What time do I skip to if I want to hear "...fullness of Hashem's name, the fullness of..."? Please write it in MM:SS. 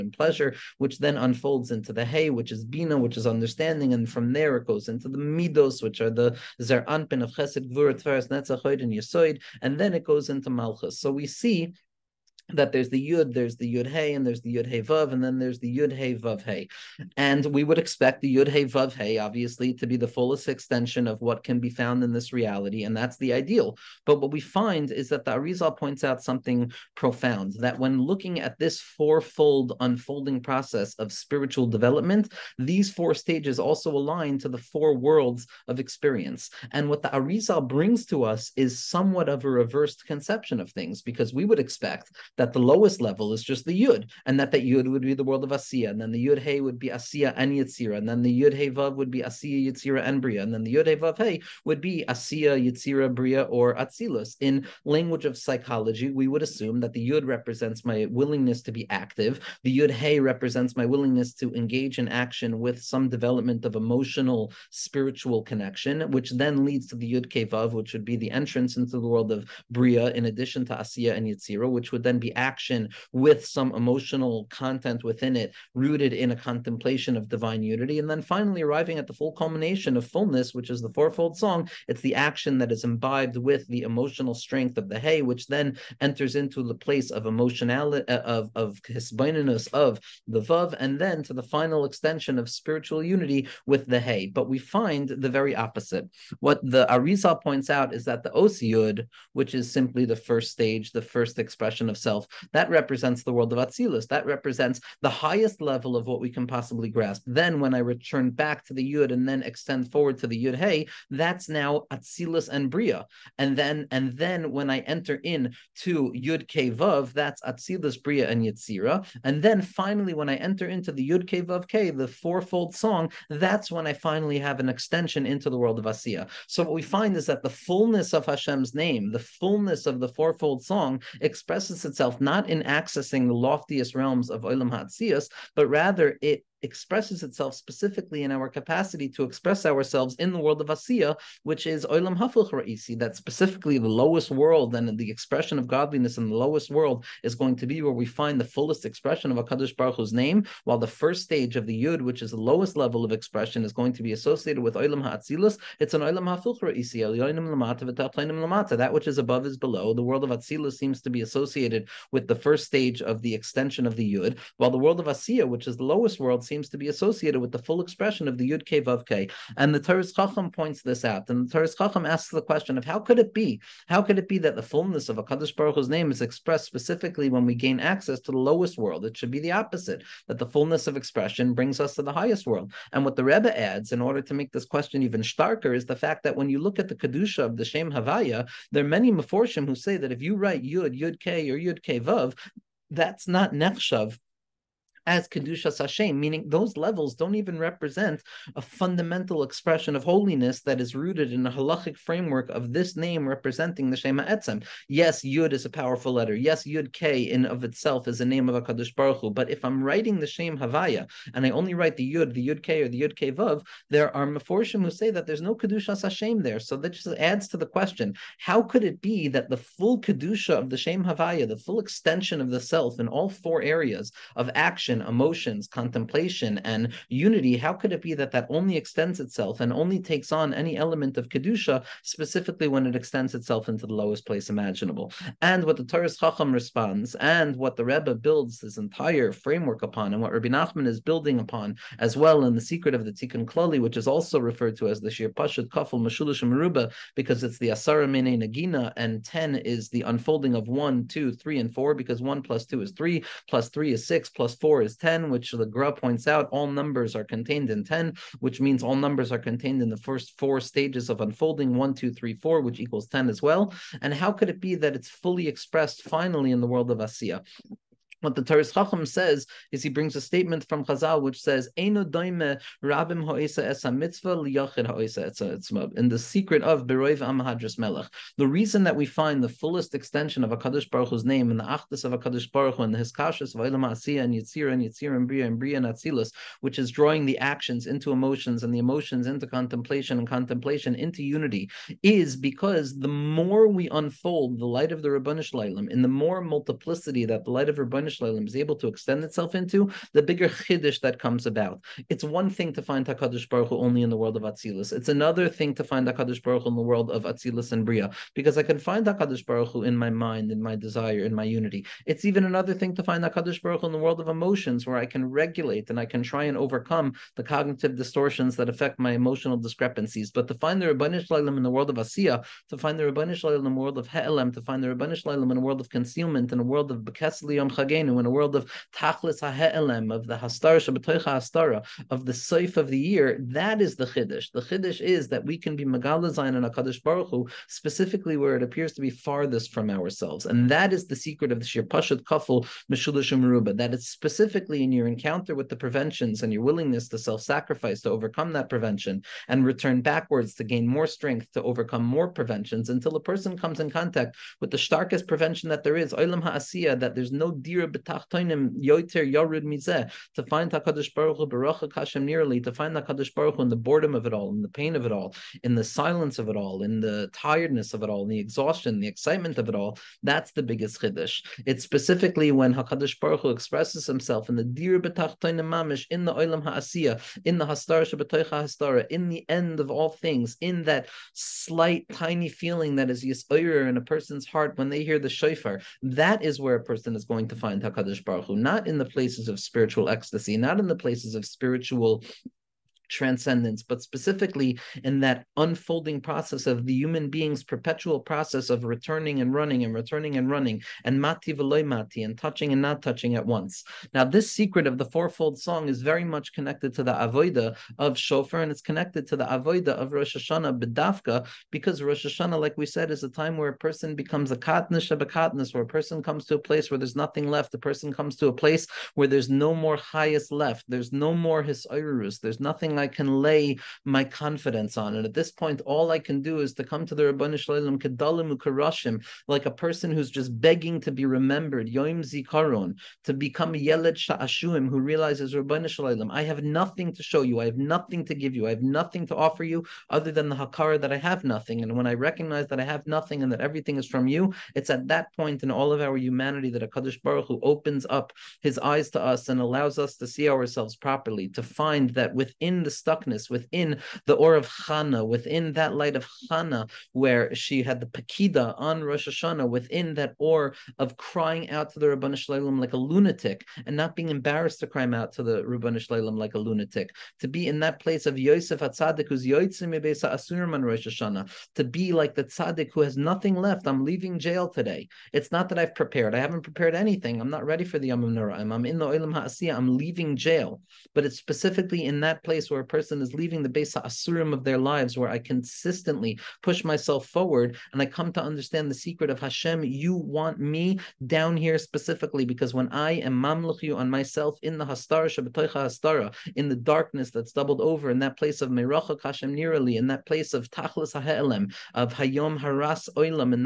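02:07.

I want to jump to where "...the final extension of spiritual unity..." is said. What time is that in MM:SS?
01:31.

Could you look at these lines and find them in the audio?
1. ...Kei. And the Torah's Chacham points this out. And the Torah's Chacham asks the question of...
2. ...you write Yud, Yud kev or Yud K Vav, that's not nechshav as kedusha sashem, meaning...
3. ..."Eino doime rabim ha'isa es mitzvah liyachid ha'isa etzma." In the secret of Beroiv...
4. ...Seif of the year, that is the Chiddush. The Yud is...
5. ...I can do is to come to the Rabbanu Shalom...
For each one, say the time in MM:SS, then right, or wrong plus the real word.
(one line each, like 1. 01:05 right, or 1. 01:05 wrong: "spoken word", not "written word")
1. 02:49 right
2. 03:10 right
3. 04:31 right
4. 05:32 wrong: "Chiddush", not "Yud"
5. 07:06 right.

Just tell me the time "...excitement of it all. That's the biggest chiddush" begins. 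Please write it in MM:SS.
06:09.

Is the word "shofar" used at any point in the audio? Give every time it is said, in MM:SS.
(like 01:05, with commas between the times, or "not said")
06:25, 06:48.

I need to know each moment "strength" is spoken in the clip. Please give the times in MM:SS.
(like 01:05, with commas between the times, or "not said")
01:24, 05:51.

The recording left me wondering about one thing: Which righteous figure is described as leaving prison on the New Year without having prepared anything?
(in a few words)
Yosef HaTzadik.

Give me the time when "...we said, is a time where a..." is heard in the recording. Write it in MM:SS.
06:52.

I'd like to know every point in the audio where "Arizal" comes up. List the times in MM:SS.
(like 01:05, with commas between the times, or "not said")
00:25, 00:37, 01:36.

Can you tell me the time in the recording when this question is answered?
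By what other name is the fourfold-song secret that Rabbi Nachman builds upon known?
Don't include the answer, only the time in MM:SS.
04:02.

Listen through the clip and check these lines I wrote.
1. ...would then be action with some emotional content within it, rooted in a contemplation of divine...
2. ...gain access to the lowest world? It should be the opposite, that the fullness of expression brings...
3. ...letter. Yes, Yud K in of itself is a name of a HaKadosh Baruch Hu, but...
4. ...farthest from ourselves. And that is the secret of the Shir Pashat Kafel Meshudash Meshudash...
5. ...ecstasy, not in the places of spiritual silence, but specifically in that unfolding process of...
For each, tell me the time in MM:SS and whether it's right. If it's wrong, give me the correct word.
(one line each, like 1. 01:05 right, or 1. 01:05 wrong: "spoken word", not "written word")
1. 01:11 right
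2. 02:57 right
3. 03:26 right
4. 05:39 wrong: "Meruba", not "Meshudash"
5. 06:30 wrong: "transcendence", not "silence".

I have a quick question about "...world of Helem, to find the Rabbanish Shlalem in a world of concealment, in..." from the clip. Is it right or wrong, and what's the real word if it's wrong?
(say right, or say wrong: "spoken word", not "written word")
right.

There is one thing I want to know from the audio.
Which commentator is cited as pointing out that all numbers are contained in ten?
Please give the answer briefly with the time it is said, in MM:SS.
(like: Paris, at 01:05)
the Gra, at 04:15.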